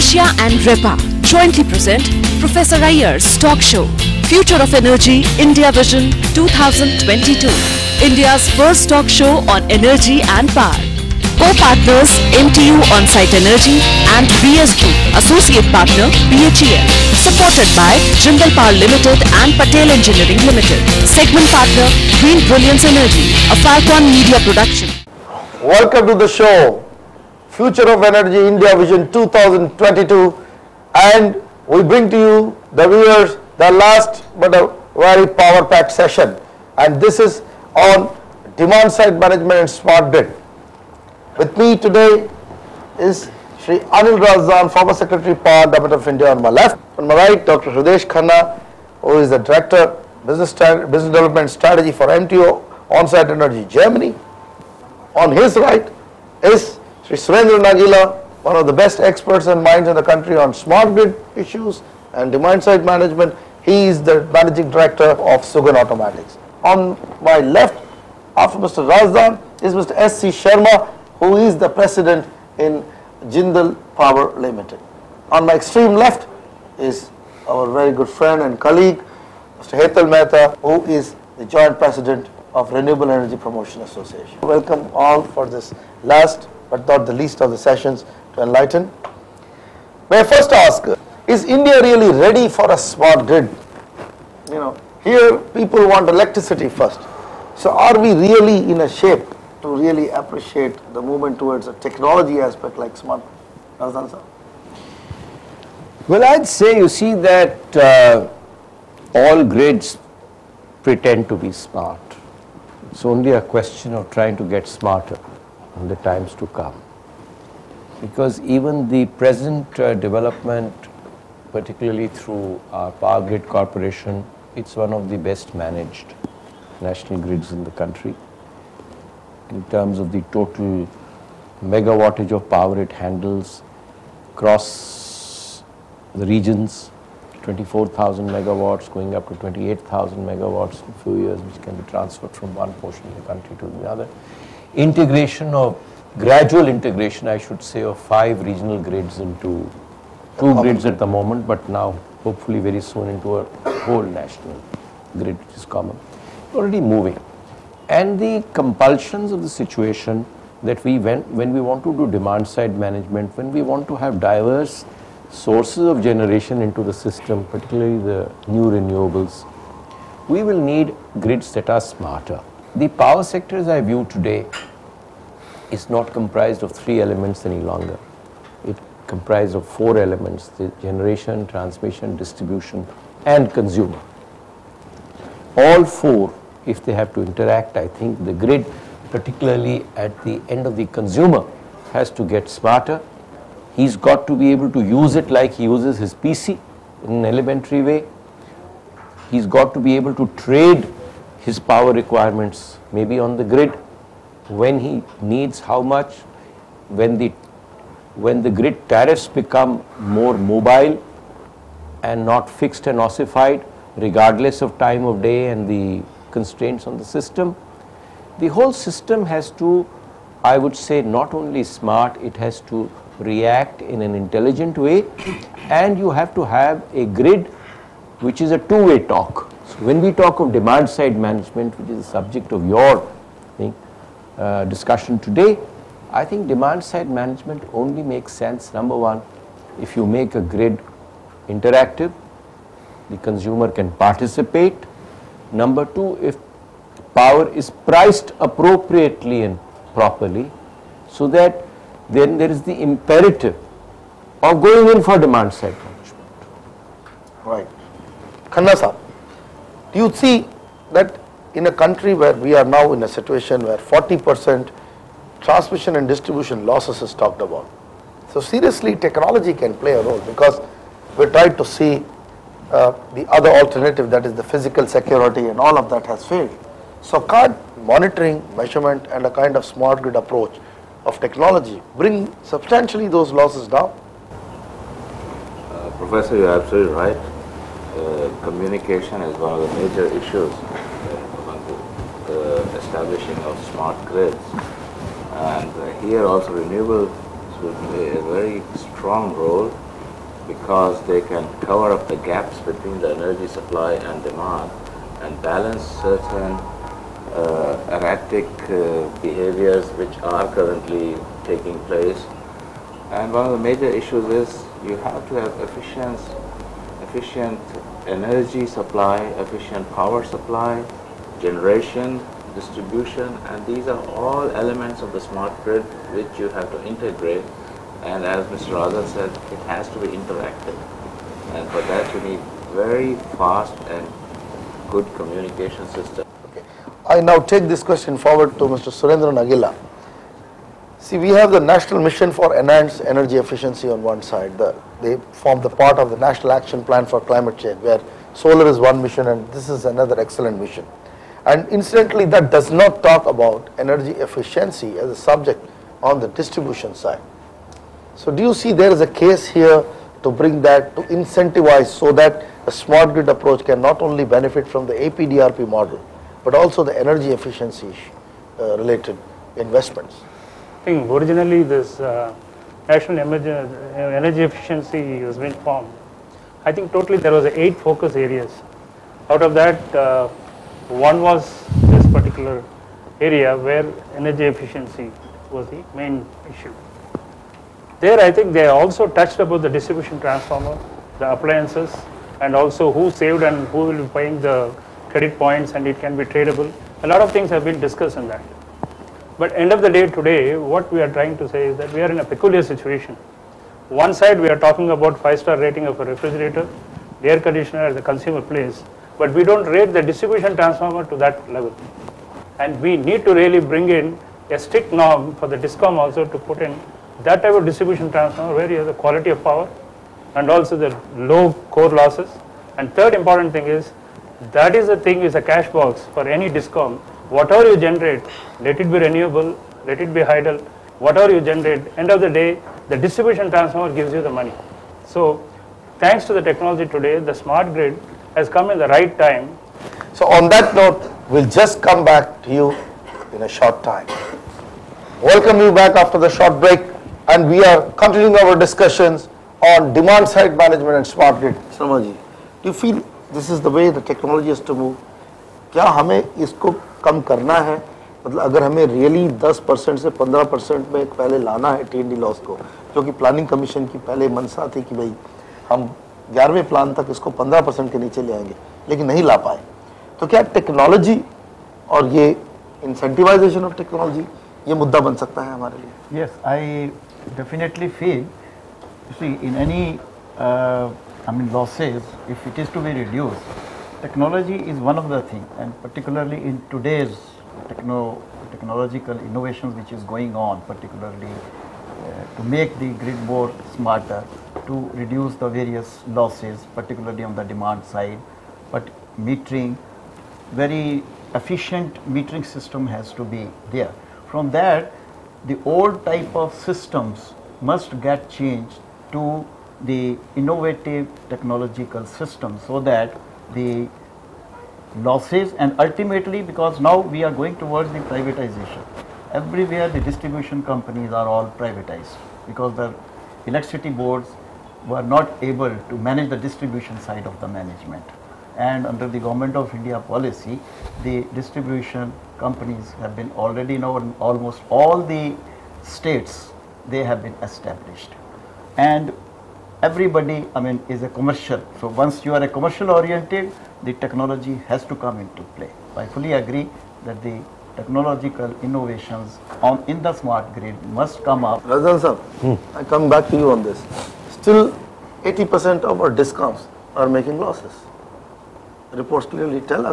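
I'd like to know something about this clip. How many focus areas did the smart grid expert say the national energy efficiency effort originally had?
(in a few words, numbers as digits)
eight.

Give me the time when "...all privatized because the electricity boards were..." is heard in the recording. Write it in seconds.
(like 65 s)
521 s.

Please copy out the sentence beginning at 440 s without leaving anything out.
So on that note, we'll just come back to you in a short time.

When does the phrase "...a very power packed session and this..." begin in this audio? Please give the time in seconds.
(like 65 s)
34 s.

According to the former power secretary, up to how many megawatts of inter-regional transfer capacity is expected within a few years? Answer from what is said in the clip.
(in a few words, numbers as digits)
28,000 megawatts.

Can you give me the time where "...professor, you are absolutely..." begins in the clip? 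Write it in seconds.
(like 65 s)
285 s.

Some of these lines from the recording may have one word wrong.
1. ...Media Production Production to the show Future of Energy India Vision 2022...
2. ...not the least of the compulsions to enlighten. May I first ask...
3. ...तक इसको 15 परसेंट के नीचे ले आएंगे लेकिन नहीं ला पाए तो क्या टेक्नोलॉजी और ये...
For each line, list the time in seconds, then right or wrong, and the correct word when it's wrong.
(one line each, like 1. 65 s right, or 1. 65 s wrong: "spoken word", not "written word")
1. 24 s wrong: "Welcome", not "Production"
2. 86 s wrong: "sessions", not "compulsions"
3. 466 s right.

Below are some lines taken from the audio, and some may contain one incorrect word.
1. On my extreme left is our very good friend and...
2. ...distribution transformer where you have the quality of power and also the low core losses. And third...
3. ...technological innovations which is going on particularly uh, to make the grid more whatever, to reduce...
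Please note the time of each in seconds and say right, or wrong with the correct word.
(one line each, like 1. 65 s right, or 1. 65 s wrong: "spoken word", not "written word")
1. 75 s right
2. 417 s right
3. 488 s wrong: "smarter", not "whatever".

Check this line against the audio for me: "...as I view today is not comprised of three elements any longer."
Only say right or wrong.
right.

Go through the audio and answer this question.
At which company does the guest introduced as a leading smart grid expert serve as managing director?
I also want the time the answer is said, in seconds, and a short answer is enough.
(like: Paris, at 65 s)
Sugan Automatics, at 65 s.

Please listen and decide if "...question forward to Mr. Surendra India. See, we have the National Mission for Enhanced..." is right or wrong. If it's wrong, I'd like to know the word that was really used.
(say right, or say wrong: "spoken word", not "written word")
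wrong: "Nagila", not "India".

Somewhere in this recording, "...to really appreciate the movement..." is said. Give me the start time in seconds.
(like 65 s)
99 s.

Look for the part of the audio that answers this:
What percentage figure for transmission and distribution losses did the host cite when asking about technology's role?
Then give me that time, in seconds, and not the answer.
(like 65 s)
263 s.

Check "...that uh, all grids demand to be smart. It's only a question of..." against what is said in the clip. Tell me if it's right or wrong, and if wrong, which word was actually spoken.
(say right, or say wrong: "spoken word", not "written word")
wrong: "pretend", not "demand".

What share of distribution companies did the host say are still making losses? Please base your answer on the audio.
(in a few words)
80%.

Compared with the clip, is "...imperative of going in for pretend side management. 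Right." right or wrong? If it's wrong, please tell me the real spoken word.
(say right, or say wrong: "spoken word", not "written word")
wrong: "demand", not "pretend".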